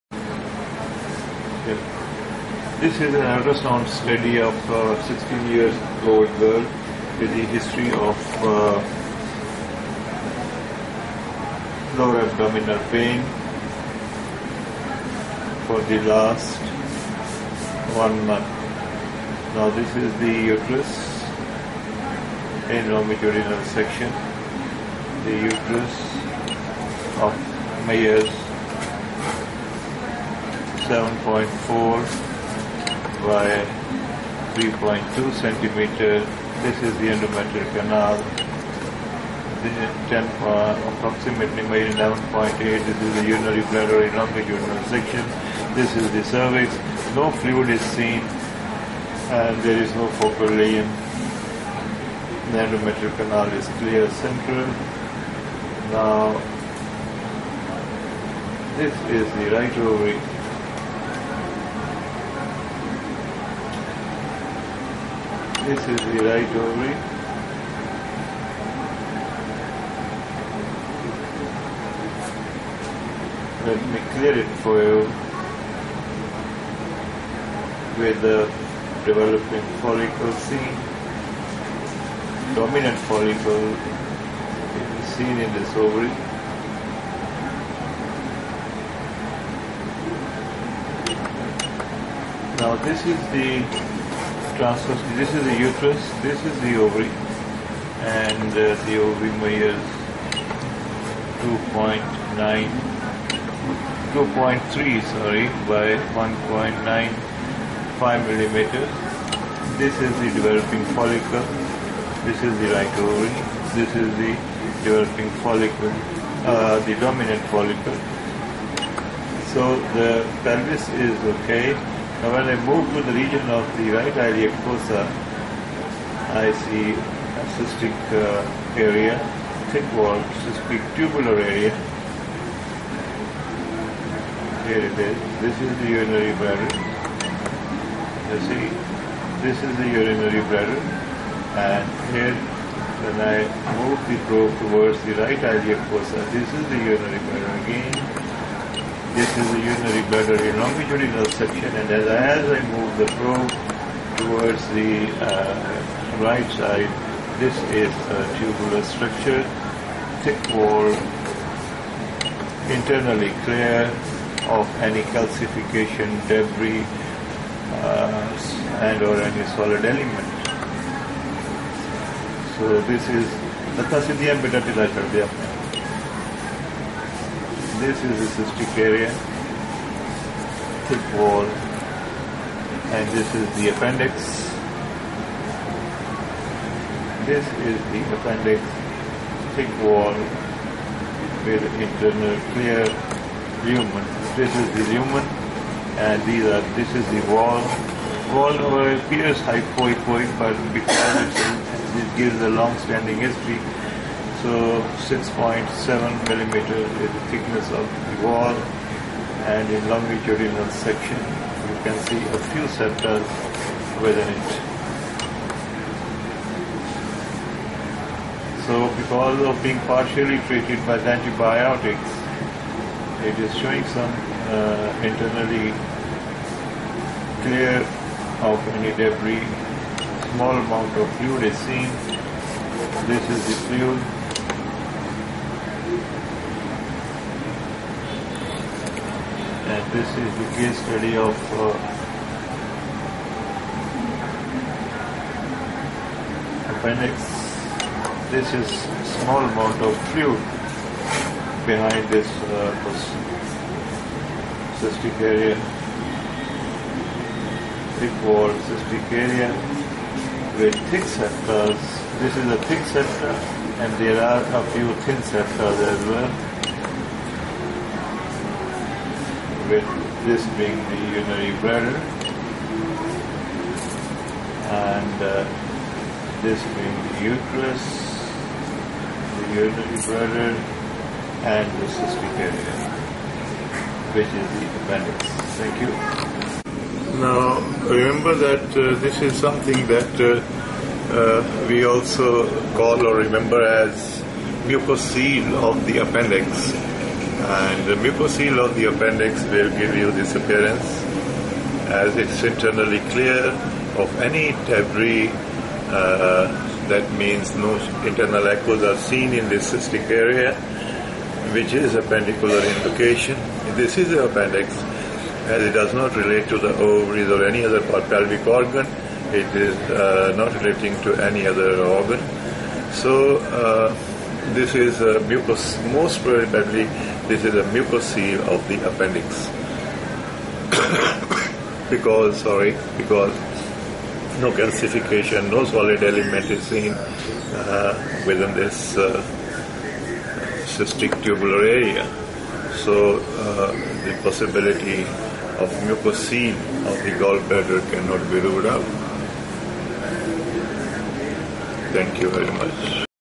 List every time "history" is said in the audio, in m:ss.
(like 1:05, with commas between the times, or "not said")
0:07, 3:23.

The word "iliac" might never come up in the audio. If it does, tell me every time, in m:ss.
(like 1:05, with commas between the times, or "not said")
2:04, 2:25.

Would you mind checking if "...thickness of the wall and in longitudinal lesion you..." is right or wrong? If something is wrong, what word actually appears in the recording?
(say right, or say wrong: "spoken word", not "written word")
wrong: "section", not "lesion".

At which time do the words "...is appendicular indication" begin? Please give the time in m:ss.
5:11.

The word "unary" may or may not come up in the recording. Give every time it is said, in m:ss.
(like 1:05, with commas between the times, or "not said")
4:31.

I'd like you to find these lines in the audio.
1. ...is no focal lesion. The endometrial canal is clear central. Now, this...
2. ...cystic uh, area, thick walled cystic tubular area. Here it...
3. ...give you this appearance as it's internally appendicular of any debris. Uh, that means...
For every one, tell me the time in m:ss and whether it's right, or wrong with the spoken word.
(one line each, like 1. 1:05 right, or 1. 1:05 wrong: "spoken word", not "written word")
1. 0:49 right
2. 2:07 right
3. 4:59 wrong: "clear", not "appendicular".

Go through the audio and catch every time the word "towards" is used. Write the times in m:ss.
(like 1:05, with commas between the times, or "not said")
2:24, 2:34.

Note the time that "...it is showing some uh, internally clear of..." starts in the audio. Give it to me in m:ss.
3:43.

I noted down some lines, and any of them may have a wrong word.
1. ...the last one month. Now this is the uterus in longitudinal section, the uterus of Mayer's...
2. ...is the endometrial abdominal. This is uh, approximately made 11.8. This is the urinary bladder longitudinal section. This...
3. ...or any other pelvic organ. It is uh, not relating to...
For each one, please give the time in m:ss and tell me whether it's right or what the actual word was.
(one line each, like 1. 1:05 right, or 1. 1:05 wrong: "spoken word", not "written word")
1. 0:15 right
2. 0:36 wrong: "canal", not "abdominal"
3. 5:17 right.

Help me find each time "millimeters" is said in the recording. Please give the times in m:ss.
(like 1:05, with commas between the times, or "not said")
1:48, 3:26.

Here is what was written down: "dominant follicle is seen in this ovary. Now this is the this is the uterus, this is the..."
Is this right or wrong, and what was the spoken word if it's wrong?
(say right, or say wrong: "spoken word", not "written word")
right.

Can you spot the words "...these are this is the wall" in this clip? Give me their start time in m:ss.
3:16.